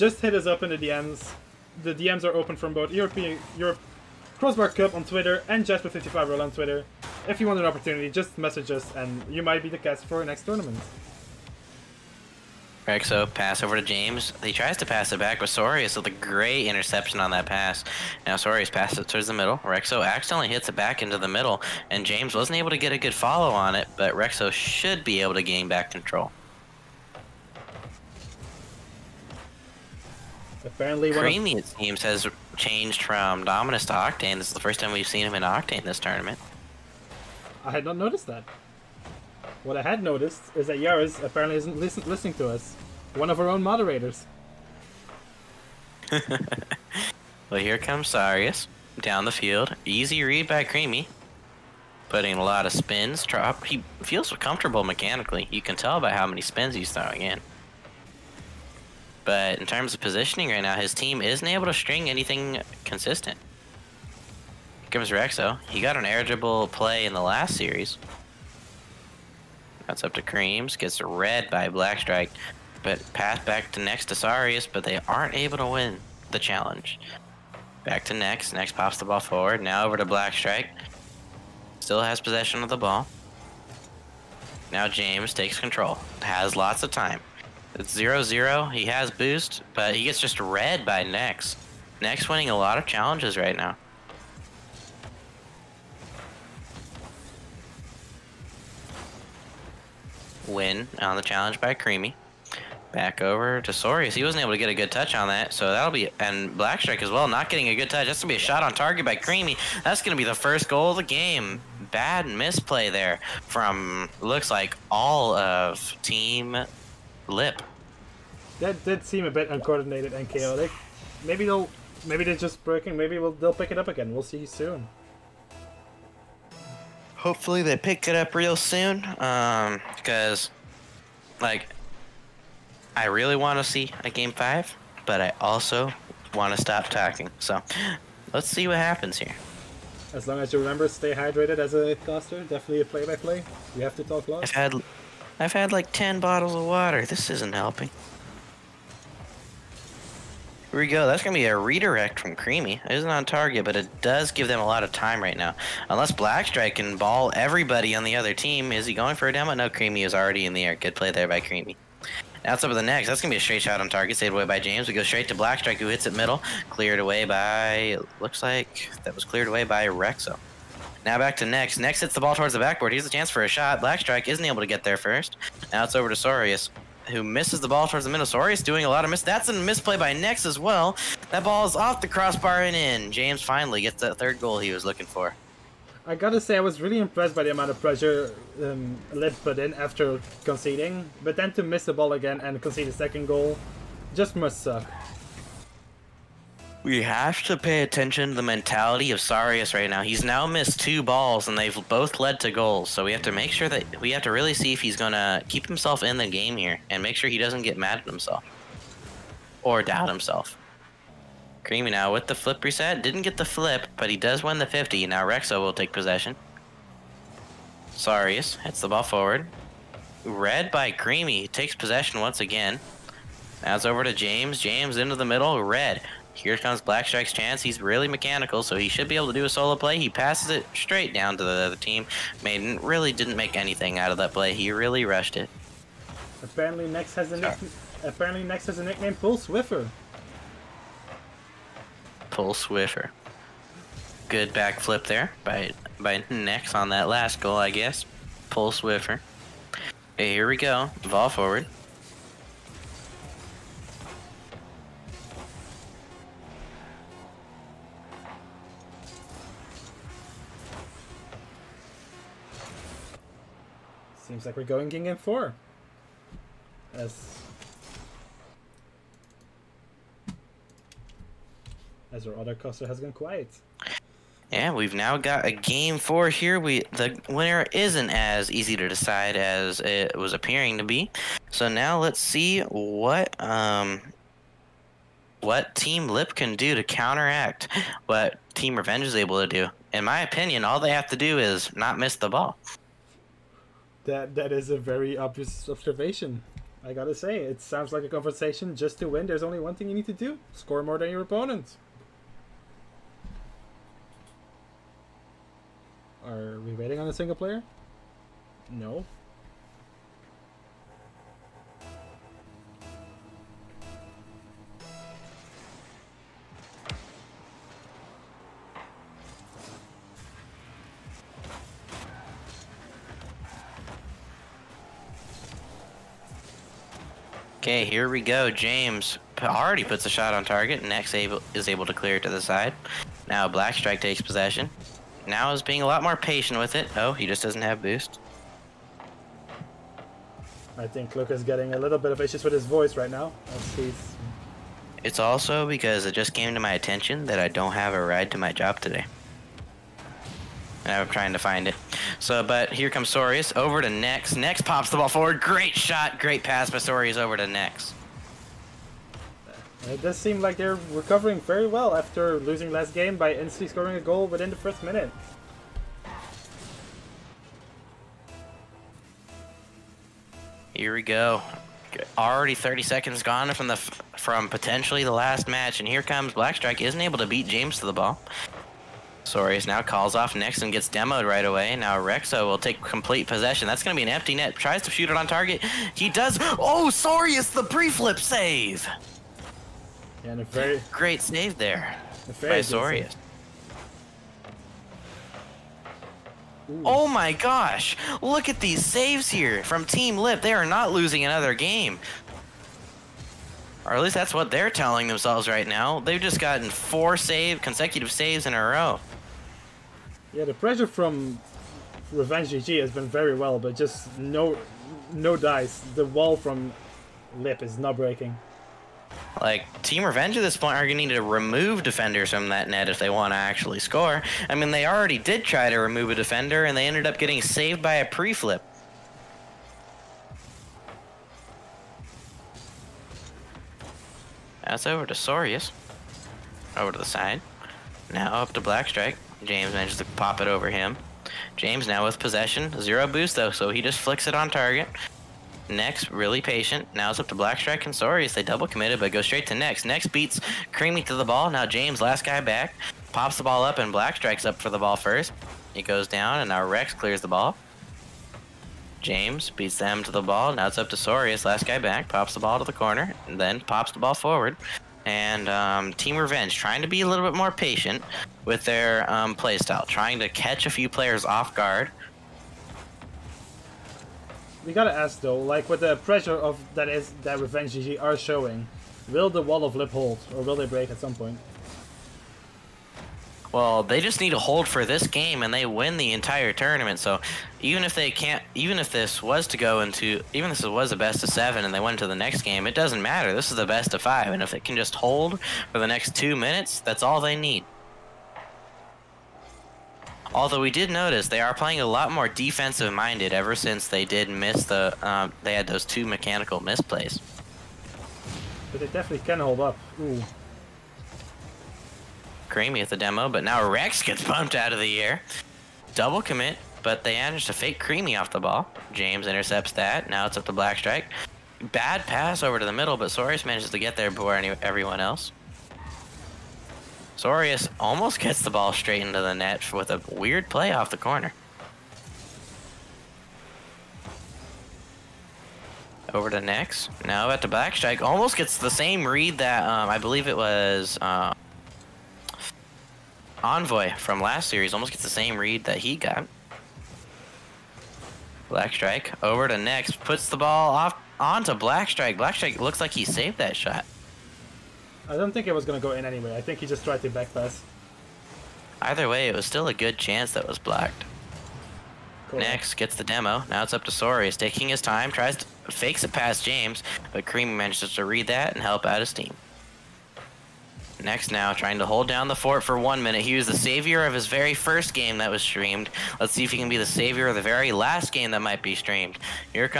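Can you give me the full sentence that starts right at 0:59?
But in terms of positioning right now, his team isn't able to string anything consistent.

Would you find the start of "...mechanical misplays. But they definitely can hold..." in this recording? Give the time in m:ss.
8:26.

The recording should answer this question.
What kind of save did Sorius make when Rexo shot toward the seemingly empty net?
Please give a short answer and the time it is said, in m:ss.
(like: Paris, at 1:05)
Pre-flip save, at 6:27.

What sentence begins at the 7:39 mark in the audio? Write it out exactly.
James beats them to the ball.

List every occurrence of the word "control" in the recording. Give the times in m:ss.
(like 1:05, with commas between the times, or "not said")
0:25, 1:25.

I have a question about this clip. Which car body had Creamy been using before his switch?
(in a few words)
Dominus.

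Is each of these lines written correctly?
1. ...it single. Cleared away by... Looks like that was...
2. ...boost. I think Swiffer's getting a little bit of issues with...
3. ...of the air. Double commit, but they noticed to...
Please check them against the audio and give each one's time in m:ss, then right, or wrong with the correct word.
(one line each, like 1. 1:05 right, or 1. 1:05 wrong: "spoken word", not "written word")
1. 2:46 wrong: "middle", not "single"
2. 5:37 wrong: "Luca", not "Swiffer"
3. 8:34 wrong: "managed", not "noticed".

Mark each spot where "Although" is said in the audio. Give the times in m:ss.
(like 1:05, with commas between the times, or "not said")
8:20.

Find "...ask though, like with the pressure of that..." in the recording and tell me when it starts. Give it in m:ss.
7:54.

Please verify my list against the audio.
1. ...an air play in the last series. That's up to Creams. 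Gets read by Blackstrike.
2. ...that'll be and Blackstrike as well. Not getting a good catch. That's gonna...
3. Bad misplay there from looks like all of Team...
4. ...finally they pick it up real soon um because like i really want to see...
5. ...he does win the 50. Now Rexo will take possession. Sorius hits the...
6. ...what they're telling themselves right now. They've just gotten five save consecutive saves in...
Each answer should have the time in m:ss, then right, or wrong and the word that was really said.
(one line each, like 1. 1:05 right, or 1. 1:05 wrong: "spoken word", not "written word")
1. 1:05 right
2. 1:45 wrong: "touch", not "catch"
3. 1:51 right
4. 2:07 wrong: "hopefully", not "finally"
5. 3:34 right
6. 6:44 wrong: "four", not "five".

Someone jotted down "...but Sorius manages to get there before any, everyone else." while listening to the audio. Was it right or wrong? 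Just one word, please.
right.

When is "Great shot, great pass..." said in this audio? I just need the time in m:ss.
5:55.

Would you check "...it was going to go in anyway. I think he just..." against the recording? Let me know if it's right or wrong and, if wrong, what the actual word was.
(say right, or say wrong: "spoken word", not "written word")
right.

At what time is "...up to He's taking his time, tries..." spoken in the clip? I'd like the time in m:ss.
9:23.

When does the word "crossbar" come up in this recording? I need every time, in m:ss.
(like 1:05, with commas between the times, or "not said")
0:04, 3:02.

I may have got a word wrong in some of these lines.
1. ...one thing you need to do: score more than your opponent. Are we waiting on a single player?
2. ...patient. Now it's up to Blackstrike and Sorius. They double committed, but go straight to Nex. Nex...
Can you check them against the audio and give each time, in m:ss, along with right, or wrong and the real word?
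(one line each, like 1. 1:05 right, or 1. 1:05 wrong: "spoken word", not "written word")
1. 4:59 right
2. 7:26 right.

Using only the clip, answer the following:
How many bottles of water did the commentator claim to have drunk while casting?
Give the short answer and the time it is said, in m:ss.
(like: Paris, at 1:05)
10, at 2:25.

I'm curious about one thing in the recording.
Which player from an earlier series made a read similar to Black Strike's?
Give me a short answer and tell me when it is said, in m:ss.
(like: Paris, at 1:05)
Envoy, at 9:03.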